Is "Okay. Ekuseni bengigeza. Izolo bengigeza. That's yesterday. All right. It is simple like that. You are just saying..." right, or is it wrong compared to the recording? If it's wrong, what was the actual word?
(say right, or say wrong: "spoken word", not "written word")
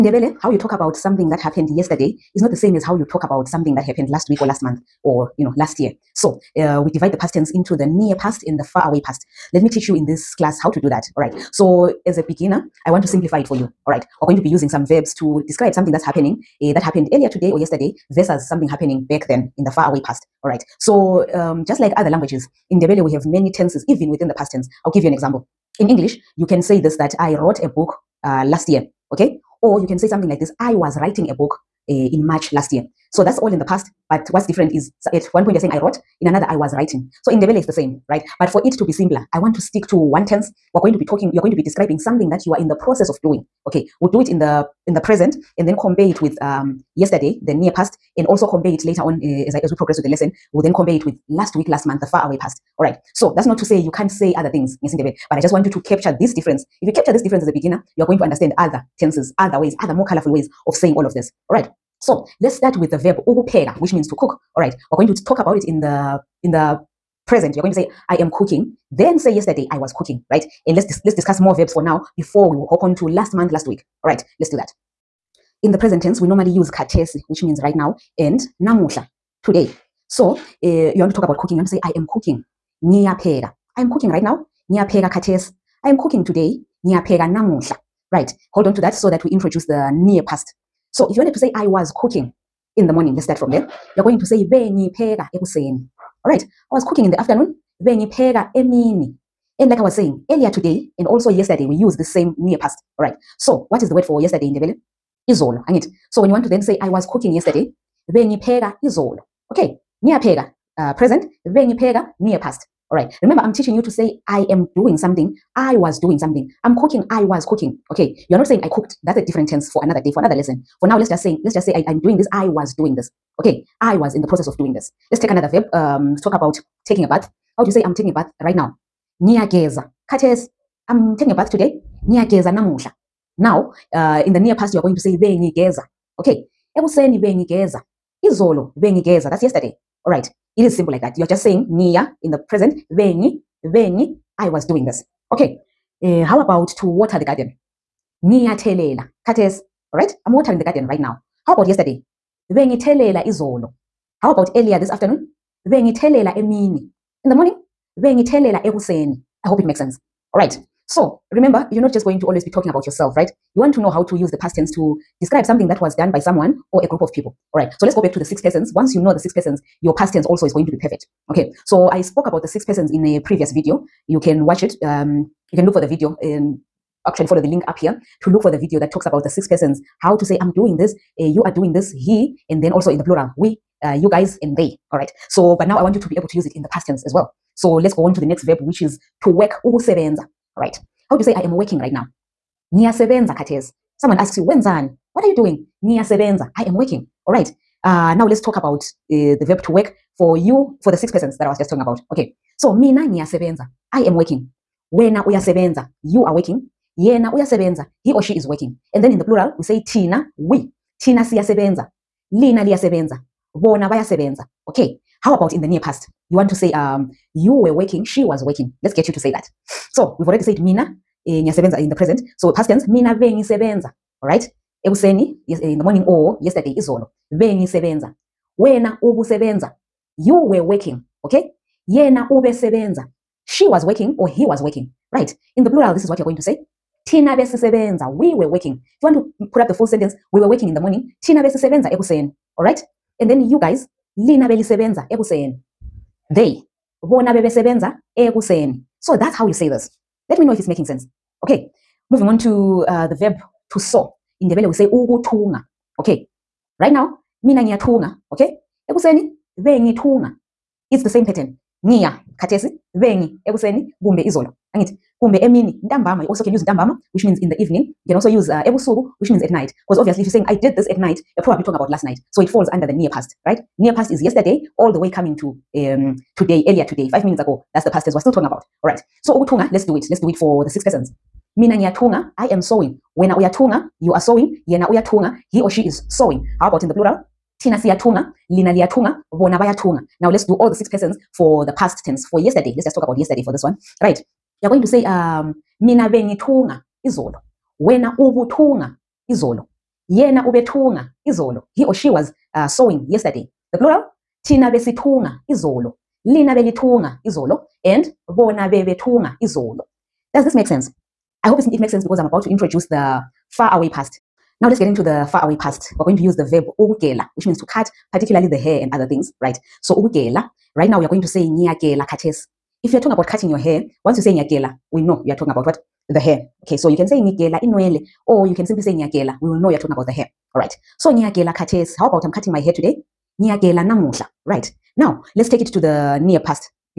right.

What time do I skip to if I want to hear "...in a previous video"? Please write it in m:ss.
2:52.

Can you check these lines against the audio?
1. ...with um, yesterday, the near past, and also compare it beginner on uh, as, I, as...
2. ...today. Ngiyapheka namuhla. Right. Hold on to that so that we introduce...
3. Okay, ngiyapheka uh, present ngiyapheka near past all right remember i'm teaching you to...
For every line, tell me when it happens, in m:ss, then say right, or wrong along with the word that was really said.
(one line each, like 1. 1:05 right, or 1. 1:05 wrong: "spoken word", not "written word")
1. 0:46 wrong: "later", not "beginner"
2. 1:26 right
3. 1:49 wrong: "bengipheka", not "ngiyapheka".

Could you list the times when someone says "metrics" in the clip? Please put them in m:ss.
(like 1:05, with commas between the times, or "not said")
not said.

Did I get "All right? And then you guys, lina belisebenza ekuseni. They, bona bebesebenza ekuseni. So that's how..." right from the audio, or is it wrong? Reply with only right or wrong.
right.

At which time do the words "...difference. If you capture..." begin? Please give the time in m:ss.
0:56.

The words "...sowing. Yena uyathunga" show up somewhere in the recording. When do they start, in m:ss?
4:44.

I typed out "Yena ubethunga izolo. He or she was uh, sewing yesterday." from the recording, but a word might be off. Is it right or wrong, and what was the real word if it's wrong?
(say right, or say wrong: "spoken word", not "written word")
right.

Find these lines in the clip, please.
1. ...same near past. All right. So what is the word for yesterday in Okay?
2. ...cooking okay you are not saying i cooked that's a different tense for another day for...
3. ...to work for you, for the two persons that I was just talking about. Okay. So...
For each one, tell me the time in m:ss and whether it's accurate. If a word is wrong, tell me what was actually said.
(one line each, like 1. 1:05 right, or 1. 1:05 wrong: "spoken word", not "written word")
1. 1:42 wrong: "Ndebele", not "Okay"
2. 1:57 right
3. 3:19 wrong: "six", not "two".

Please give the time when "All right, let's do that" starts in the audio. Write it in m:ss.
1:14.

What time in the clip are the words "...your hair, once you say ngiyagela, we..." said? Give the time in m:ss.
5:23.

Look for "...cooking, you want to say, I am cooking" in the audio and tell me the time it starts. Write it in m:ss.
1:21.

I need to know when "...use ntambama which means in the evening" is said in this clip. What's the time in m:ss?
4:26.